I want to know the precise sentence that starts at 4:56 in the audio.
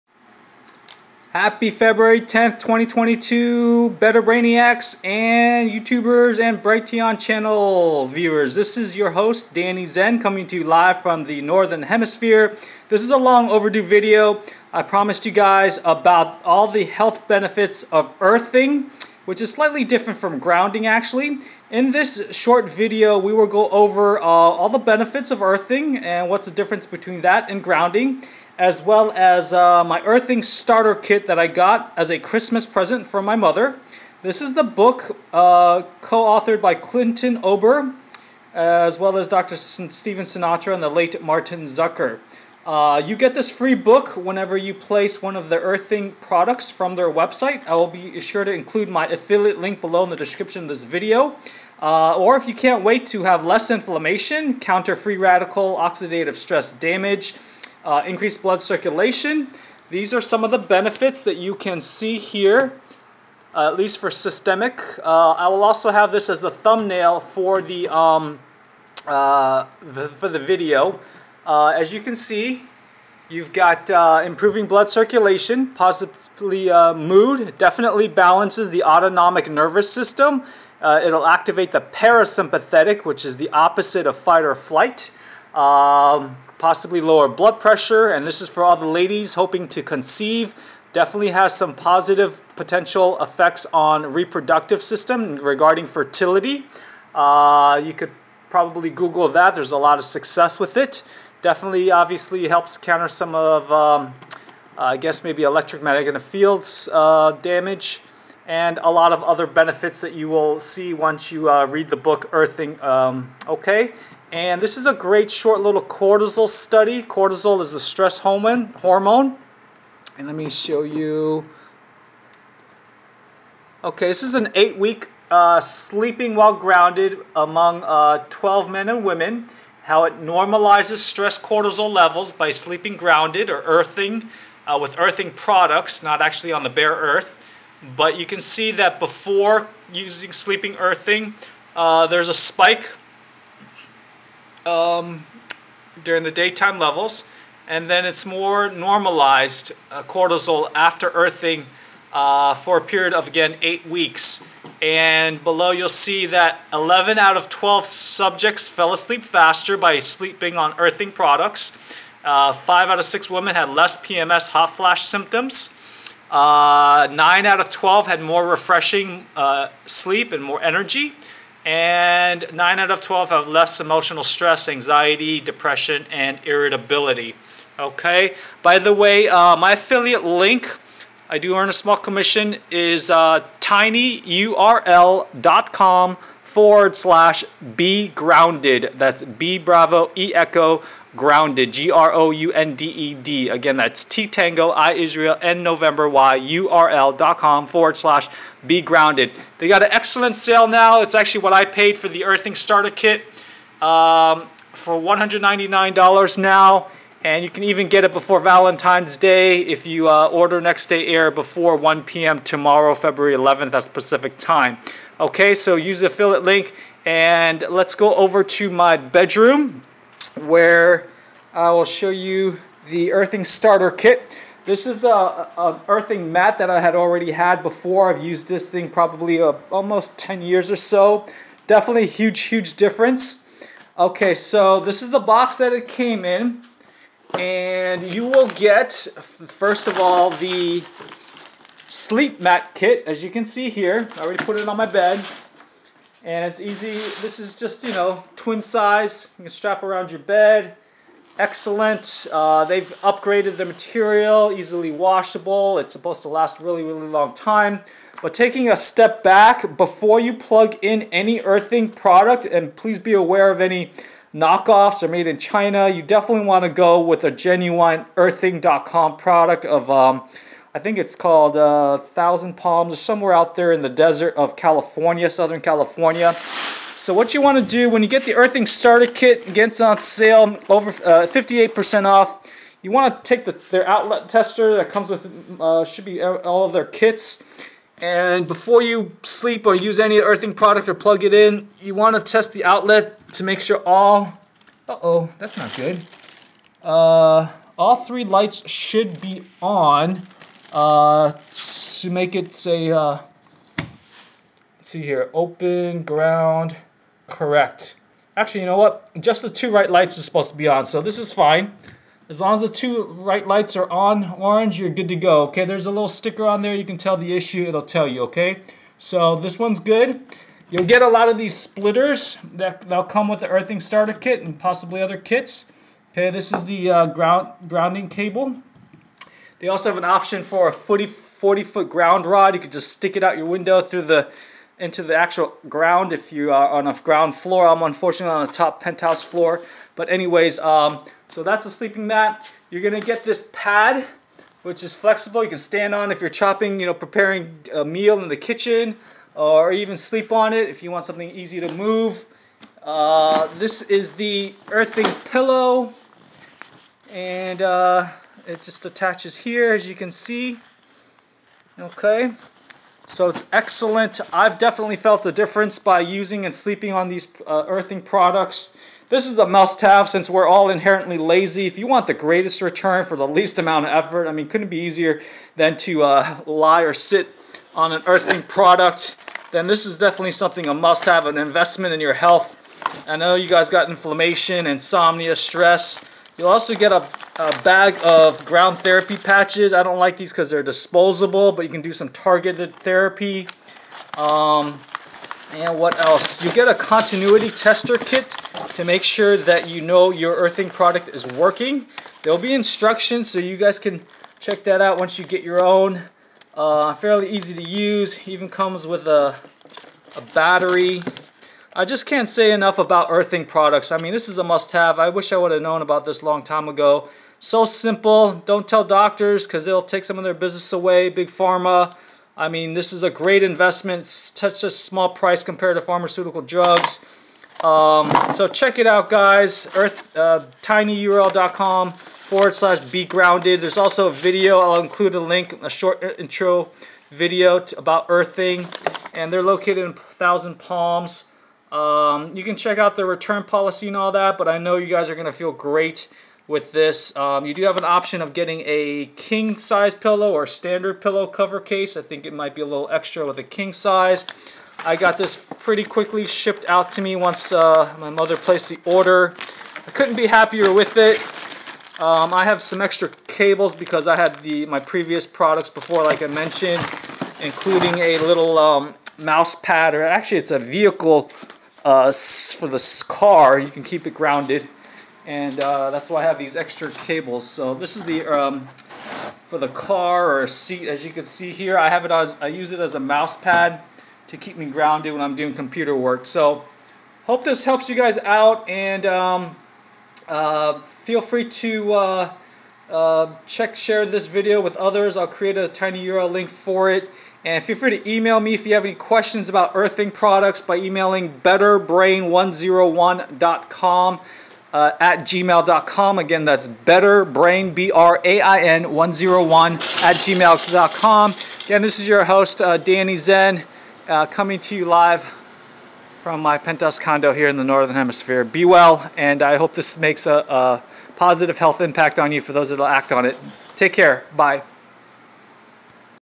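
Uh, all three lights should be on uh, to make it say, uh, see here, open, ground, correct.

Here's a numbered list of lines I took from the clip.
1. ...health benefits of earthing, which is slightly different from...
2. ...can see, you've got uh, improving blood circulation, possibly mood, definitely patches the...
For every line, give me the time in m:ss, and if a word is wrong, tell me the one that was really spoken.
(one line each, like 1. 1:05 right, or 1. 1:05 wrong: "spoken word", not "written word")
1. 0:16 right
2. 1:12 wrong: "balances", not "patches".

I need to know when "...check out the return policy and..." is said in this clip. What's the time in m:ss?
7:22.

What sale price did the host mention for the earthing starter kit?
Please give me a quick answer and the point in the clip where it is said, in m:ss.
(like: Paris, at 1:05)
$199, at 3:24.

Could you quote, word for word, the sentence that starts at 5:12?
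As long as the two right lights are on orange, you're good to go, okay?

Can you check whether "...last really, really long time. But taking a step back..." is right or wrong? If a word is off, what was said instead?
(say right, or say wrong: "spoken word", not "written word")
right.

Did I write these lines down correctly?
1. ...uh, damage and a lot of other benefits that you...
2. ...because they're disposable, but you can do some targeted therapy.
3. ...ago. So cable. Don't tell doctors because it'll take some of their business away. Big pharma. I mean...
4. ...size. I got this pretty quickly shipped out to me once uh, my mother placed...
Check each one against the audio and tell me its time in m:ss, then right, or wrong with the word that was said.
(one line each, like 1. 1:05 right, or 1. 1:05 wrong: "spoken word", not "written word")
1. 1:46 right
2. 6:30 right
3. 6:56 wrong: "simple", not "cable"
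4. 7:33 right.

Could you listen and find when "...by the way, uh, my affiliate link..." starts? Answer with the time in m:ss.
2:58.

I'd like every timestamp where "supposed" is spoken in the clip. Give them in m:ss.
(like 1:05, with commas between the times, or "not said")
4:15, 5:10.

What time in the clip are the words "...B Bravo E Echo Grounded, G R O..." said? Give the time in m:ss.
3:09.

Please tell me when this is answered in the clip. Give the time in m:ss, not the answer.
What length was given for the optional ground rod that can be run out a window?
5:31.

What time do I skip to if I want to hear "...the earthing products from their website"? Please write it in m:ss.
0:45.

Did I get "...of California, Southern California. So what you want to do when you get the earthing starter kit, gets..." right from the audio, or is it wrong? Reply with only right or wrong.
right.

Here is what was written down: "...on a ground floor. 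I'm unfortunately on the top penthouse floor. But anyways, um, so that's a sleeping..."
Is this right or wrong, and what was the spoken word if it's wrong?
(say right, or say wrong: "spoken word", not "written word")
right.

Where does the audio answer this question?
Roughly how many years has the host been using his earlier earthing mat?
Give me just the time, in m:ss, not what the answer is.
3:49.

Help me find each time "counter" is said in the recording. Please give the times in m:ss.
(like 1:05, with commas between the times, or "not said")
0:54, 1:42.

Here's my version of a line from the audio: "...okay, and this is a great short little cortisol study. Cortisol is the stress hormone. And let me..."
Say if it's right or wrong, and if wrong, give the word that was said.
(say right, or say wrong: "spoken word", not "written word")
right.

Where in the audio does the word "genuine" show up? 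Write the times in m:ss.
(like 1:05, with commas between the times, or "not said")
4:27.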